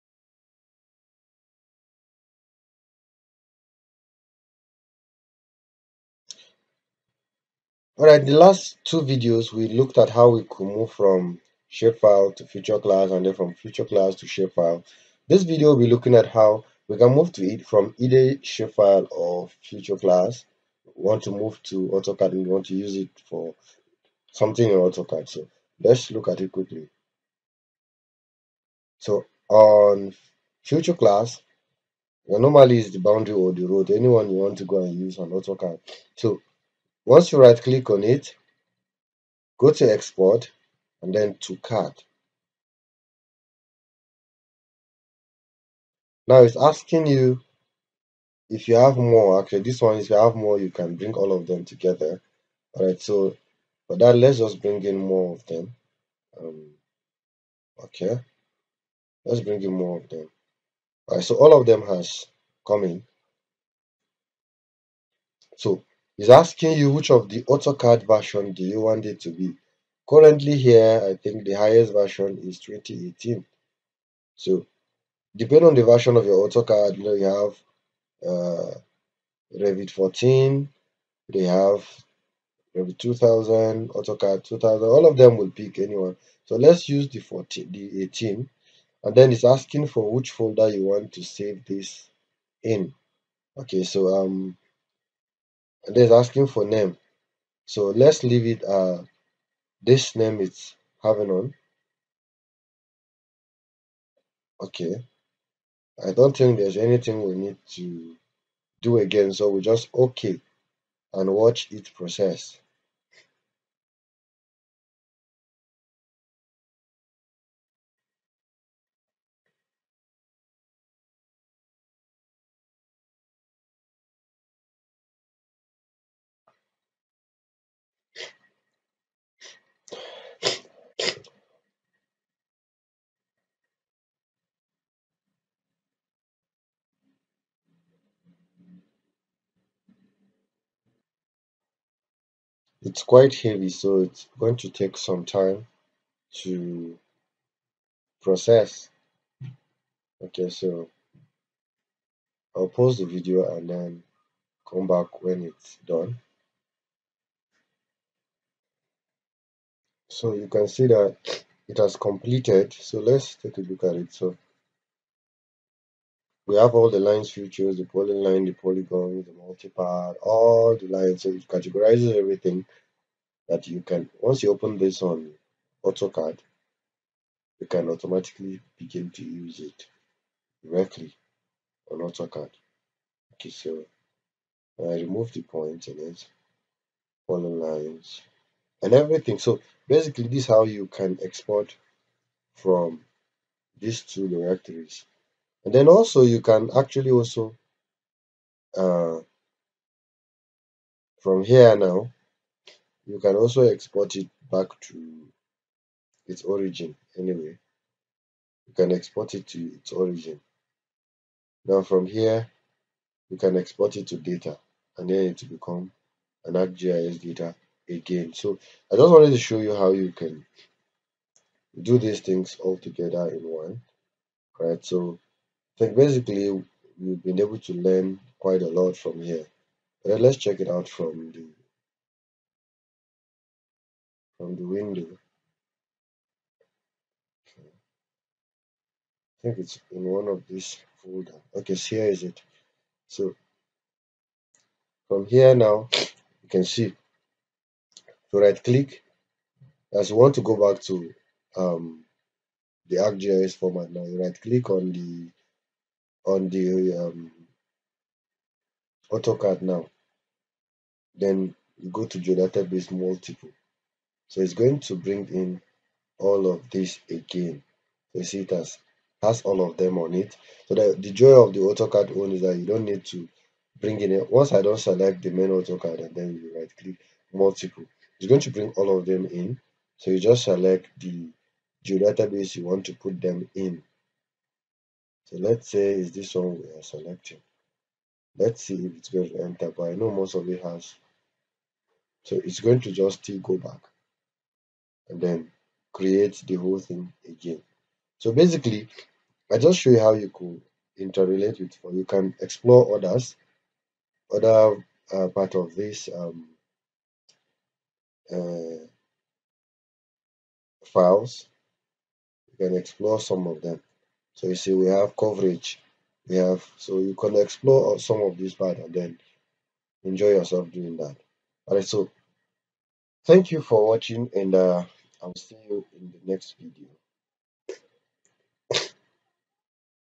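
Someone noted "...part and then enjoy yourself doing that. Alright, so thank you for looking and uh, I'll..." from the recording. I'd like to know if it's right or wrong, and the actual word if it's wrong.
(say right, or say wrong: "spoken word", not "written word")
wrong: "watching", not "looking".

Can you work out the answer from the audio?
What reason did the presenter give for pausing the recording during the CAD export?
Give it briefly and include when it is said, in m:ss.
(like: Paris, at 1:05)
it's quite heavy, at 2:22.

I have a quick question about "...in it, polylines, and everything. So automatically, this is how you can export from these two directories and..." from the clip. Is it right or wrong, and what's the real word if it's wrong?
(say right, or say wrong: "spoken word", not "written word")
wrong: "basically", not "automatically".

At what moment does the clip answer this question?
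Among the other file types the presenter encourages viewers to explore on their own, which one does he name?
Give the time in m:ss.
5:15.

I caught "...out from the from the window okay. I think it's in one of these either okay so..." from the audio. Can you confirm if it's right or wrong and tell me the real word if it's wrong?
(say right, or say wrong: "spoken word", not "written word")
wrong: "folder", not "either".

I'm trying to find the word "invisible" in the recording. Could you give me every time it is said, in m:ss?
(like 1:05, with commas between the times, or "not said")
not said.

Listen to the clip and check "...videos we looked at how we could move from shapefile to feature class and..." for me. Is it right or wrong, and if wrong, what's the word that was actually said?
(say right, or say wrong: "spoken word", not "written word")
right.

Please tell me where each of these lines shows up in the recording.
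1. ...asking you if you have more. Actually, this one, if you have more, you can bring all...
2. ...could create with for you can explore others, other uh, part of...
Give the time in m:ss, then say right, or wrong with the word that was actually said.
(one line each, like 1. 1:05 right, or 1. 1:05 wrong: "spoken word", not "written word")
1. 0:46 right
2. 5:00 wrong: "interrelate", not "create".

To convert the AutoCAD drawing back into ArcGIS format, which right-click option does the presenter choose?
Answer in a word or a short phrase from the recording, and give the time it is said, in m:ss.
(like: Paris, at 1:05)
geodatabase multiple, at 4:22.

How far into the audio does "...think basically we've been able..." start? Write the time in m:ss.
3:45.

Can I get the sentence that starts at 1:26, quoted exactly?
So let's use the 14, the 18, and then it's asking for which folder you want to save this in.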